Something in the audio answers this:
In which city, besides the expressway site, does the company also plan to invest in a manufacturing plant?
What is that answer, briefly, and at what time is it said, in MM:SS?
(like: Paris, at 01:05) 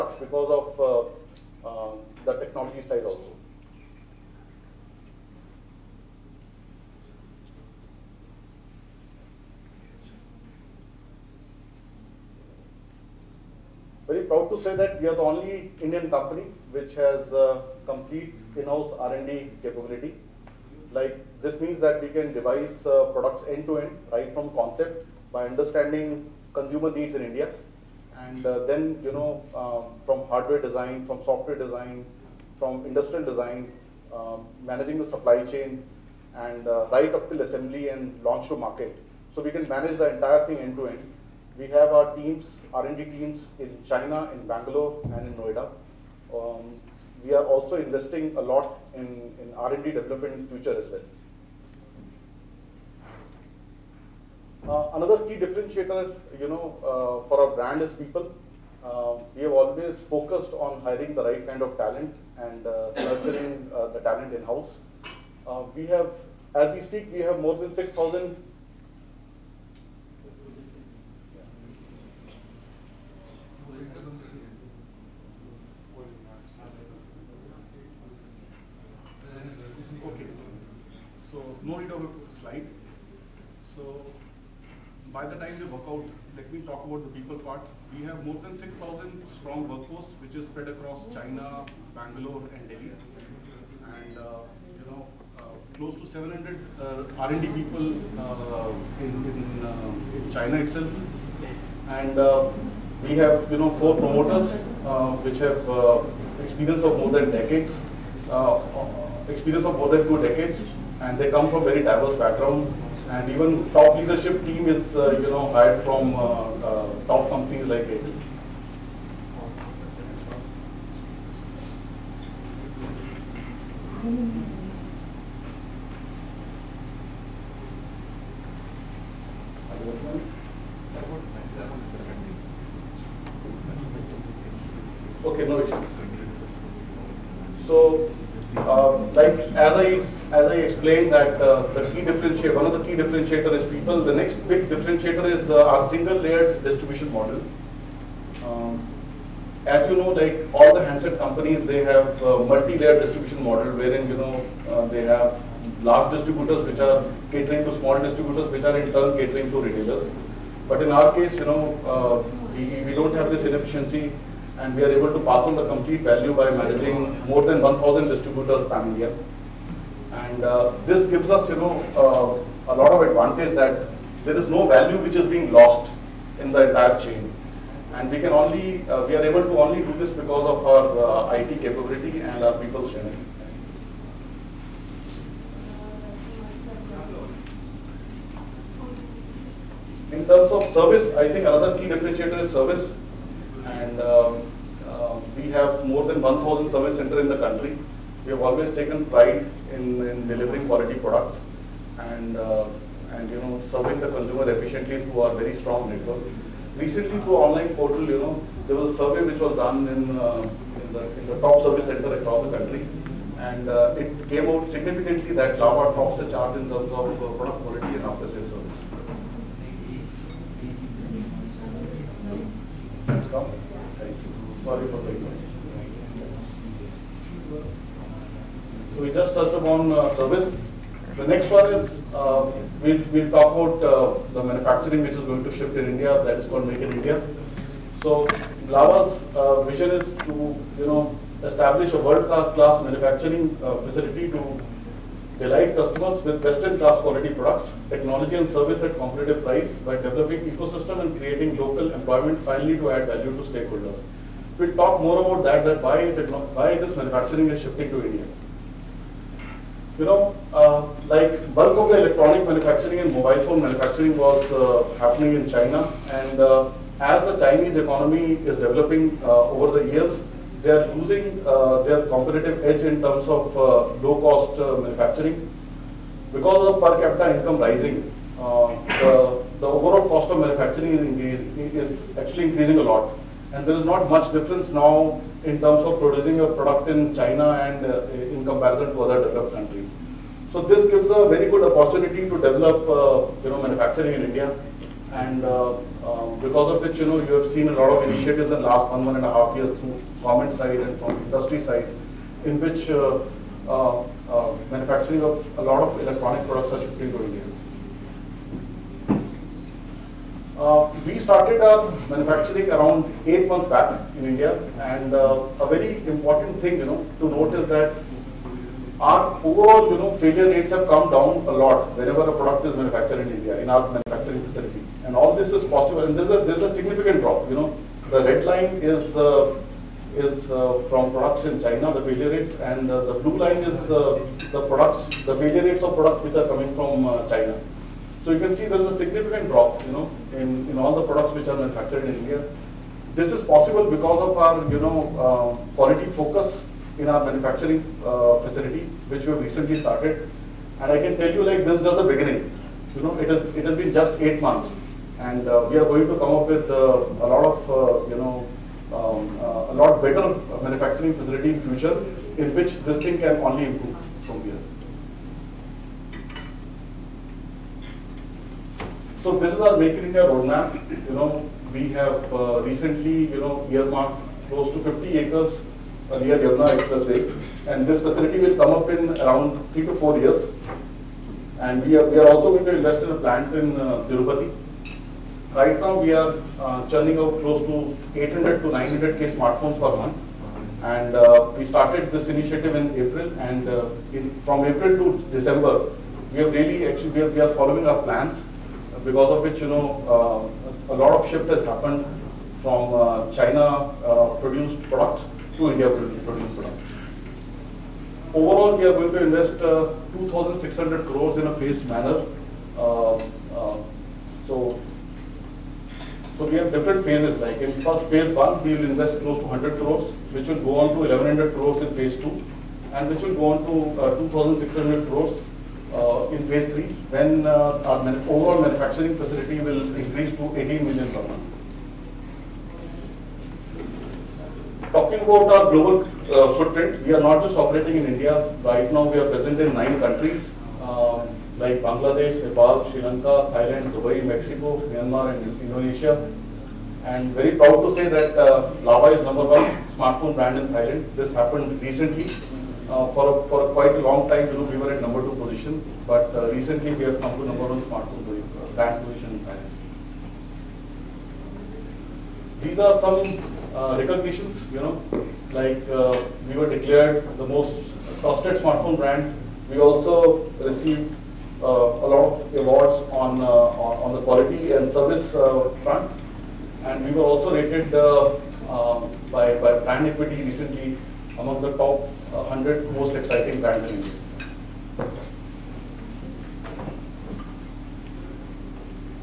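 Tirupati, at 06:24.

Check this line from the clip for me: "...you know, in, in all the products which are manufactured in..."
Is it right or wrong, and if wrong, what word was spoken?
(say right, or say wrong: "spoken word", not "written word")
right.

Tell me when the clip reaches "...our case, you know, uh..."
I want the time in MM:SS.
02:40.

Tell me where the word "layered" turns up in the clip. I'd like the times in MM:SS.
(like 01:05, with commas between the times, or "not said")
02:26, 02:32.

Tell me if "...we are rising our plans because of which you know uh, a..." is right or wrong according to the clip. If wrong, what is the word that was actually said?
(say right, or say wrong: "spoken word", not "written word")
wrong: "following", not "rising".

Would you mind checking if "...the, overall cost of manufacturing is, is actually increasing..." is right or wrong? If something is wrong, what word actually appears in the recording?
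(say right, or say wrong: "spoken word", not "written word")
right.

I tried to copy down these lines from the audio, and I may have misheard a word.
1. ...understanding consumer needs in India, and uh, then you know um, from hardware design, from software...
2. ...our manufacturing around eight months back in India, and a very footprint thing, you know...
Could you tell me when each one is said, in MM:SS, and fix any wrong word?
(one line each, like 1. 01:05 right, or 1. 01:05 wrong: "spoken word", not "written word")
1. 00:25 right
2. 05:11 wrong: "important", not "footprint".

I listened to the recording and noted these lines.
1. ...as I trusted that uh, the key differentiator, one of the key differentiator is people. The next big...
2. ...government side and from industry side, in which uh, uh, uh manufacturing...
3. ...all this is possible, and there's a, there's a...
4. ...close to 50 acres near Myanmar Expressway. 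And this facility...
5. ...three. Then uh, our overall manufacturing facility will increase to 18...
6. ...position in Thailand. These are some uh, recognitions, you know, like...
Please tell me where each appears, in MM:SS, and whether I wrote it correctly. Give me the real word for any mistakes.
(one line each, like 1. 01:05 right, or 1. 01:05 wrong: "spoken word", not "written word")
1. 02:20 wrong: "explained", not "trusted"
2. 05:00 right
3. 05:25 right
4. 06:14 wrong: "Yamuna", not "Myanmar"
5. 07:06 right
6. 07:39 right.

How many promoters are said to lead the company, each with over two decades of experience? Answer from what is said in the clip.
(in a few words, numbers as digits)
4.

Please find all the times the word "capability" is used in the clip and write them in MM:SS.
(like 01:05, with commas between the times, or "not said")
00:19, 03:01.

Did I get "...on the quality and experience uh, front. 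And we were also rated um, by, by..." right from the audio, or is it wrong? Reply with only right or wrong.
wrong.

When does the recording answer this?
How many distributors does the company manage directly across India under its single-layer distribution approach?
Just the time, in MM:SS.
02:47.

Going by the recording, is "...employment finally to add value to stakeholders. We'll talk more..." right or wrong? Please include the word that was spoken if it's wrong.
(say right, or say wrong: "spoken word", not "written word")
right.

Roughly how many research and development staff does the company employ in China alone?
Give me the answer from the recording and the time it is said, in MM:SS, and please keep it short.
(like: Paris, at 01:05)
700, at 01:35.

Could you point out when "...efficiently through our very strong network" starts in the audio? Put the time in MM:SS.
03:24.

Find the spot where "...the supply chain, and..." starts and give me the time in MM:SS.
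00:34.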